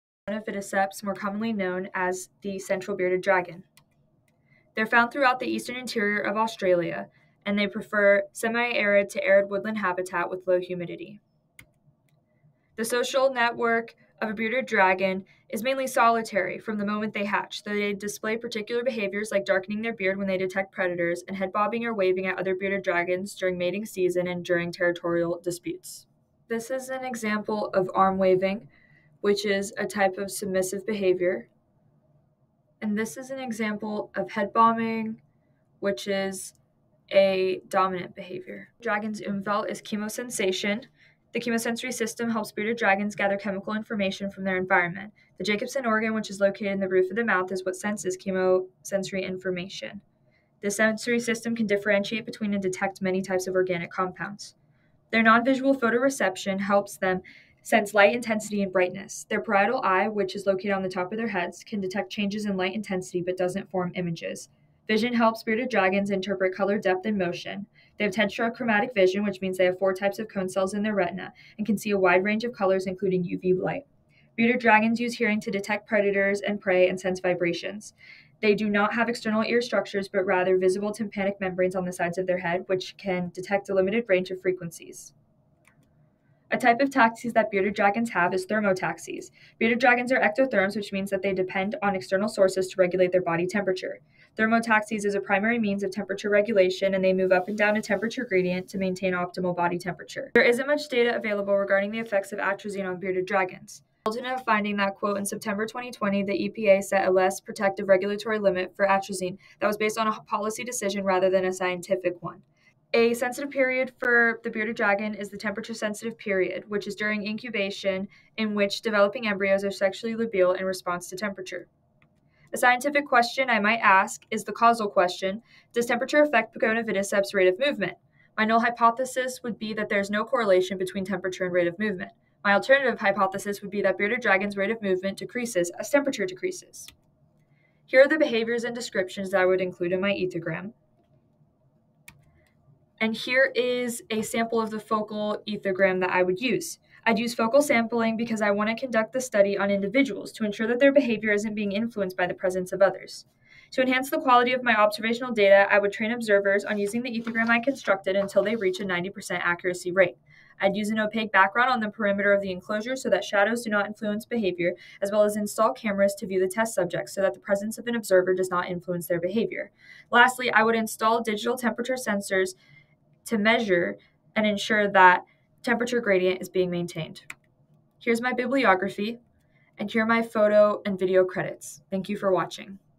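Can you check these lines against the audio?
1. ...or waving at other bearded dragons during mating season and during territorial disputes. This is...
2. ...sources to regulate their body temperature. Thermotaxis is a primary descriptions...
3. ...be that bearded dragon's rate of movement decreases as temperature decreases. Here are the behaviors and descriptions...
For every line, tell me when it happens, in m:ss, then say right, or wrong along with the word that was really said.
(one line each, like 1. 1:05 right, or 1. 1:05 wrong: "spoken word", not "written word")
1. 0:21 right
2. 1:32 wrong: "means", not "descriptions"
3. 2:13 right.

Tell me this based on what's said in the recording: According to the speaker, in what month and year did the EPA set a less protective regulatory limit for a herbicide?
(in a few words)
September 2020.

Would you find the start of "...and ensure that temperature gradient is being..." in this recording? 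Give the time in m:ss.
2:54.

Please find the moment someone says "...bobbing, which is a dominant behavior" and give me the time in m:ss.
0:34.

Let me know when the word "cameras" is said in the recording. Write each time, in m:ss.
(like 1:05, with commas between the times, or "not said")
2:45.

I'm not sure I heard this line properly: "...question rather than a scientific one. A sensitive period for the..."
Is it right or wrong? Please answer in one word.
wrong.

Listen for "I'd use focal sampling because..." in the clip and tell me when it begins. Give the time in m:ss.
2:27.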